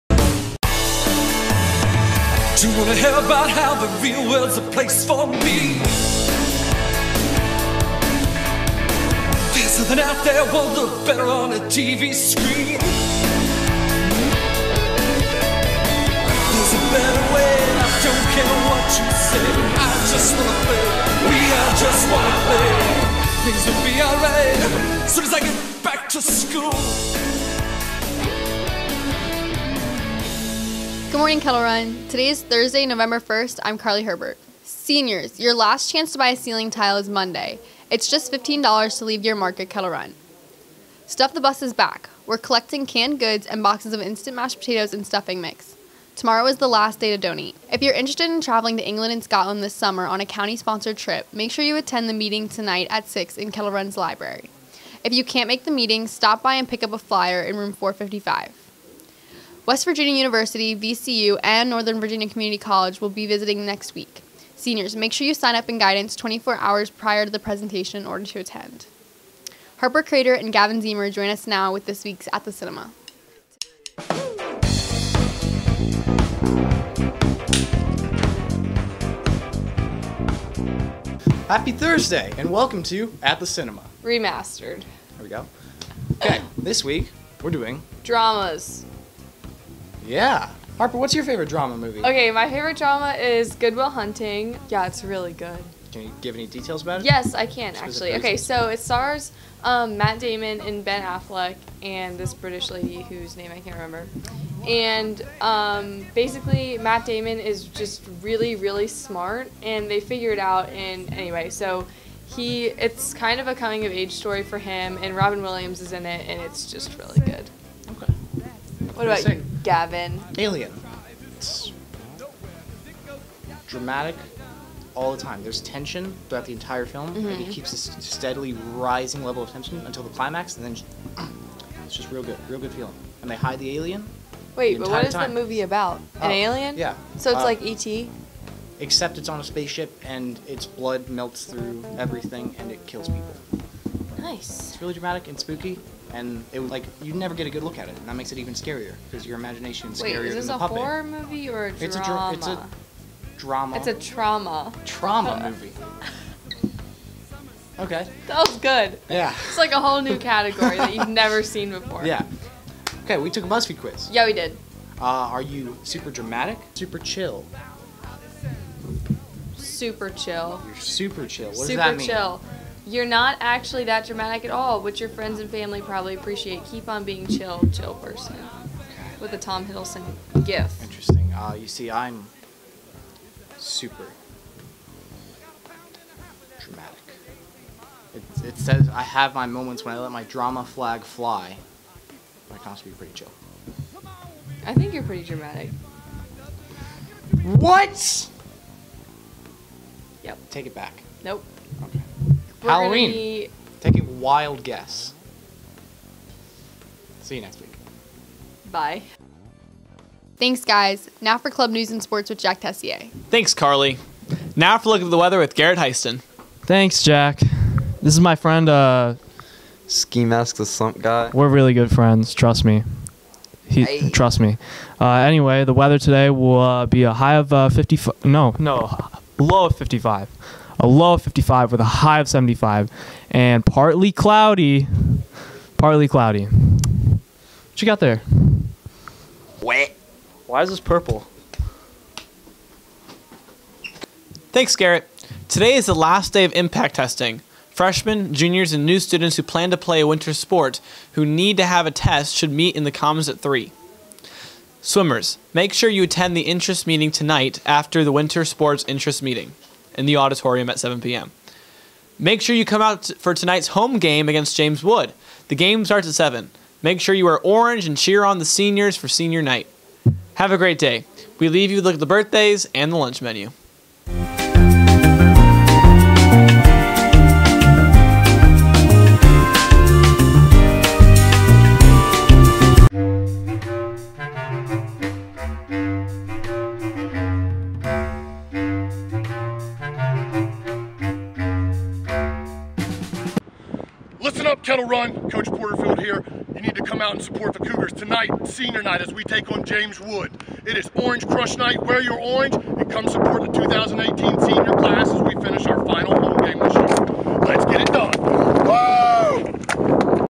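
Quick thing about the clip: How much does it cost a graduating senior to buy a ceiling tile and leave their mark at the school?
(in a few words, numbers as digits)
$15.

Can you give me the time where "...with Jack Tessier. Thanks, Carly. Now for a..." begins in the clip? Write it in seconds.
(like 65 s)
212 s.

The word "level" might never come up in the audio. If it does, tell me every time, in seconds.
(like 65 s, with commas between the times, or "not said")
129 s.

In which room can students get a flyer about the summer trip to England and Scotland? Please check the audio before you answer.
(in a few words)
455.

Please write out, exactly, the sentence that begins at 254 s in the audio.
Swimmers, make sure you attend the interest meeting tonight after the winter sports interest meeting in the auditorium at 7 p.m.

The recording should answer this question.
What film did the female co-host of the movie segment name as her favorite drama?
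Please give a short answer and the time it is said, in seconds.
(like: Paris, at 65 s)
Good Will Hunting, at 93 s.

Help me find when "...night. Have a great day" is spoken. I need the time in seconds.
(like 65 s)
269 s.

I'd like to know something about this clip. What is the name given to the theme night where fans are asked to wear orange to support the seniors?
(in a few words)
Orange Crush Night.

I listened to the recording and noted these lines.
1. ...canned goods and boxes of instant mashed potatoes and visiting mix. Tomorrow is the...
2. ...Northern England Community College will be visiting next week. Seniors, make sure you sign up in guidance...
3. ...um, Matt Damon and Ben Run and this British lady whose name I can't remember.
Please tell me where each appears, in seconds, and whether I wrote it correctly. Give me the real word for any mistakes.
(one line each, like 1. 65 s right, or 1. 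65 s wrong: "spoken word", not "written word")
1. 42 s wrong: "stuffing", not "visiting"
2. 61 s wrong: "Virginia", not "England"
3. 99 s wrong: "Affleck", not "Run".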